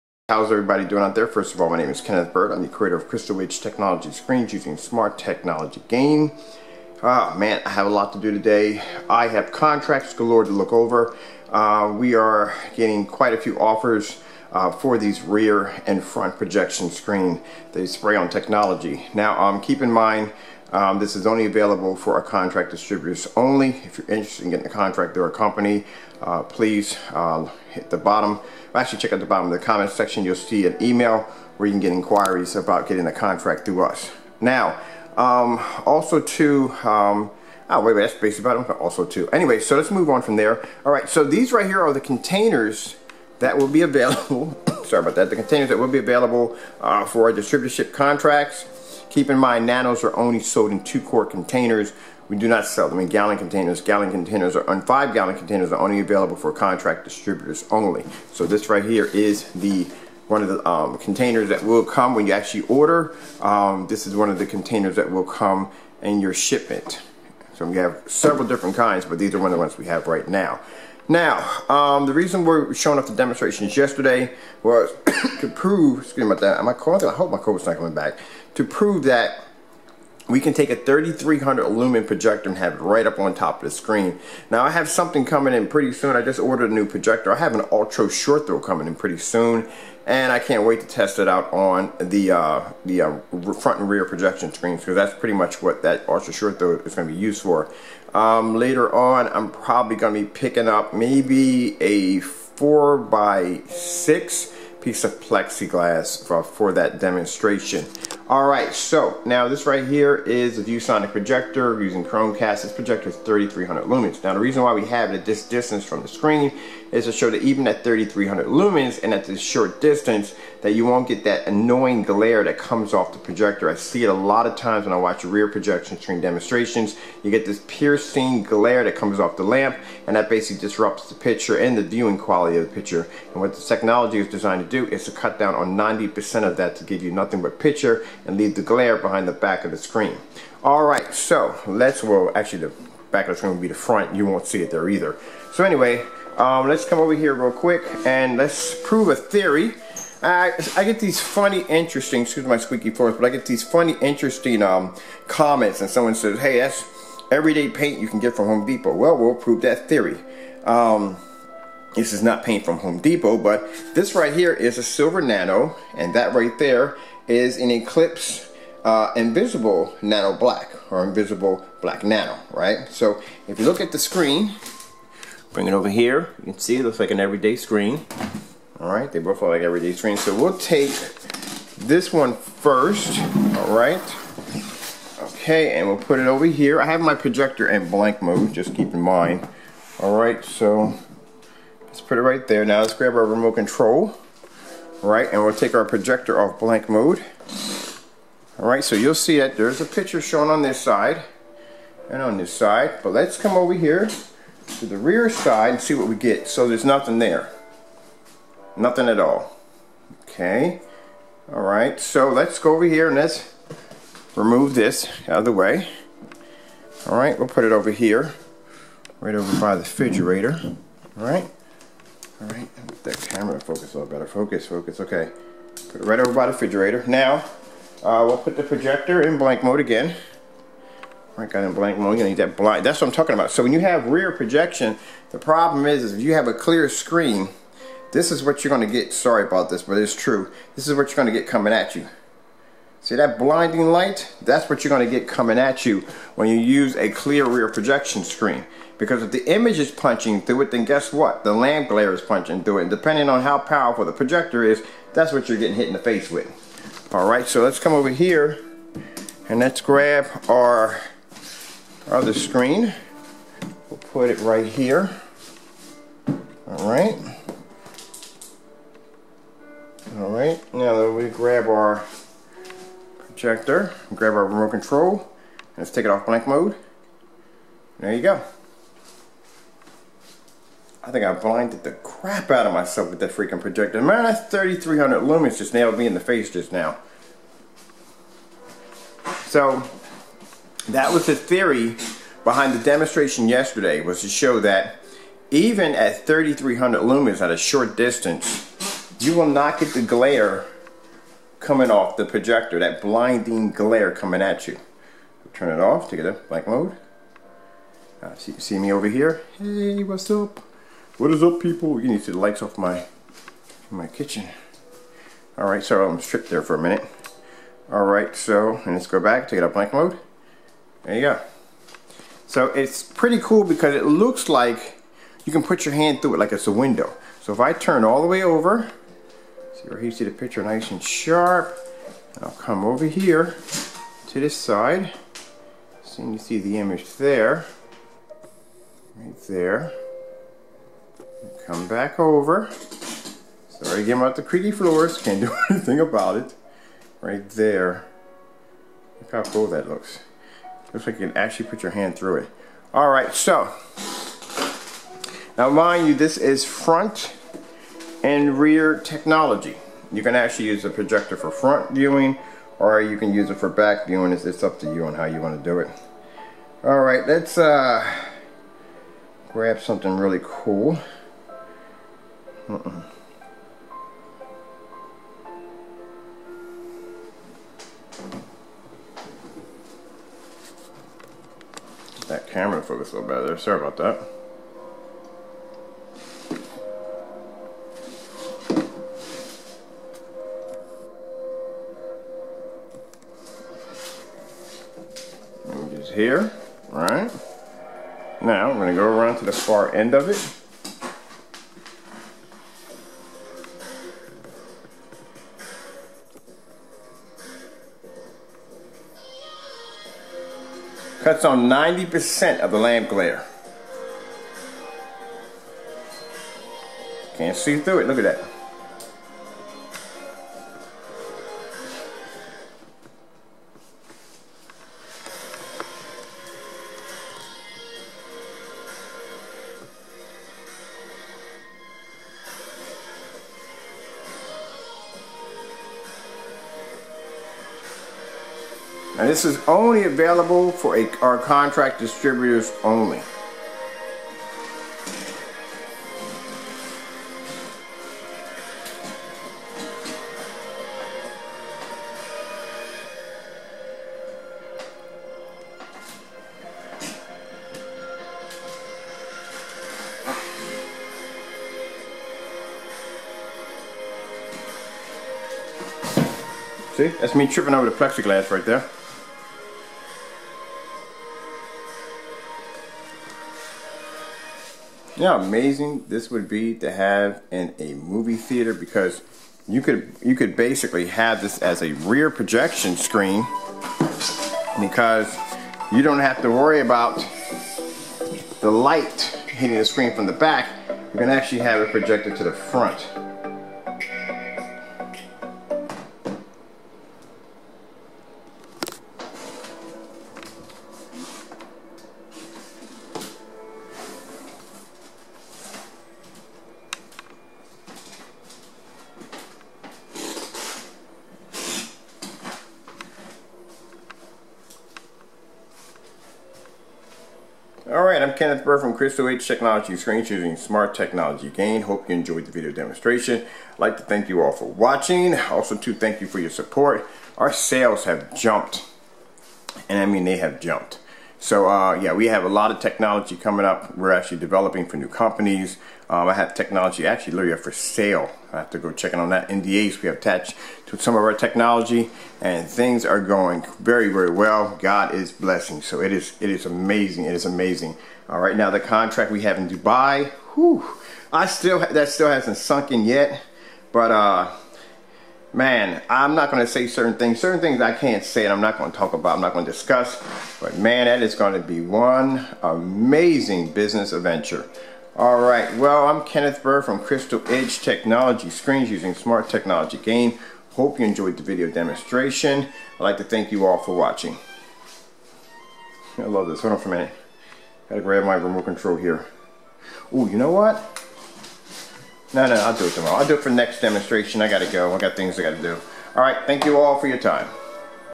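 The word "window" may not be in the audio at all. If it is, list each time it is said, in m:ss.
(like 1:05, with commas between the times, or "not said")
5:26.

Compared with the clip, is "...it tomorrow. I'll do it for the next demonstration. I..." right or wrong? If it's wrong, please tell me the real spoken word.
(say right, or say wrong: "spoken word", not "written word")
right.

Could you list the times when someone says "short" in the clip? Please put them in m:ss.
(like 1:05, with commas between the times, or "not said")
1:28, 1:36, 1:59, 4:57.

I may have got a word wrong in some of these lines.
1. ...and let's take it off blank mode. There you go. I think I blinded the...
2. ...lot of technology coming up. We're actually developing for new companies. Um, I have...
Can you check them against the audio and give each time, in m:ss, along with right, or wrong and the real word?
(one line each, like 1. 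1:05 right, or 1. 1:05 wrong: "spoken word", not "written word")
1. 4:35 right
2. 8:52 right.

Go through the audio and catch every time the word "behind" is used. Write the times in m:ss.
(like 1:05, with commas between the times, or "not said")
2:18, 4:52.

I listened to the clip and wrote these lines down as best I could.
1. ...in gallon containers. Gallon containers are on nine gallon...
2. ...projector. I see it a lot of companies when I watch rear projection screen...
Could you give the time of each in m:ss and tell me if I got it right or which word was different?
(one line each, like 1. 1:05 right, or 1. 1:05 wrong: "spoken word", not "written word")
1. 0:52 wrong: "five", not "nine"
2. 2:03 wrong: "times", not "companies".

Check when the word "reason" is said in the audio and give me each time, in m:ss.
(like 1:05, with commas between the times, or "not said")
1:12, 1:54.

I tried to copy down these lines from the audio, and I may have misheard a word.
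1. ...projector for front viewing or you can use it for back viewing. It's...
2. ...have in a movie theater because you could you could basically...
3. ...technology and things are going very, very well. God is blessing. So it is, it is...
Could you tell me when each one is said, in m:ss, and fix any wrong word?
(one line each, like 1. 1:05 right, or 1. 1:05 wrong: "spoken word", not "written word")
1. 6:00 right
2. 7:56 right
3. 9:01 right.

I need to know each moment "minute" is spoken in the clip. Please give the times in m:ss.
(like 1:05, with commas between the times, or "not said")
5:16, 9:36.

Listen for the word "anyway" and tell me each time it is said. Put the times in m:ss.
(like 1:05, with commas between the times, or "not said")
0:39, 2:25.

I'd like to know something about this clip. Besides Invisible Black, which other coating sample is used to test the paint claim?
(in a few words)
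Silver Nano.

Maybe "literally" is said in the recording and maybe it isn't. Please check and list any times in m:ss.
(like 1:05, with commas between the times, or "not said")
8:57.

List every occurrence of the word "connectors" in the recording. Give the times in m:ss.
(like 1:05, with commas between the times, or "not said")
not said.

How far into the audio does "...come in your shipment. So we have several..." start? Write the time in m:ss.
1:05.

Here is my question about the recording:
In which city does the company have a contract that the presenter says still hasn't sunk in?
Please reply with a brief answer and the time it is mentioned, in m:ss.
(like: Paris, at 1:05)
Dubai, at 9:09.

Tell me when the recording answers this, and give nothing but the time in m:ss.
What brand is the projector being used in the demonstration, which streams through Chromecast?
1:50.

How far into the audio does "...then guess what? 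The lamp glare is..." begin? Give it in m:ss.
4:10.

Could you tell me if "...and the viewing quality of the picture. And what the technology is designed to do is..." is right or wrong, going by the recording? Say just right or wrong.
right.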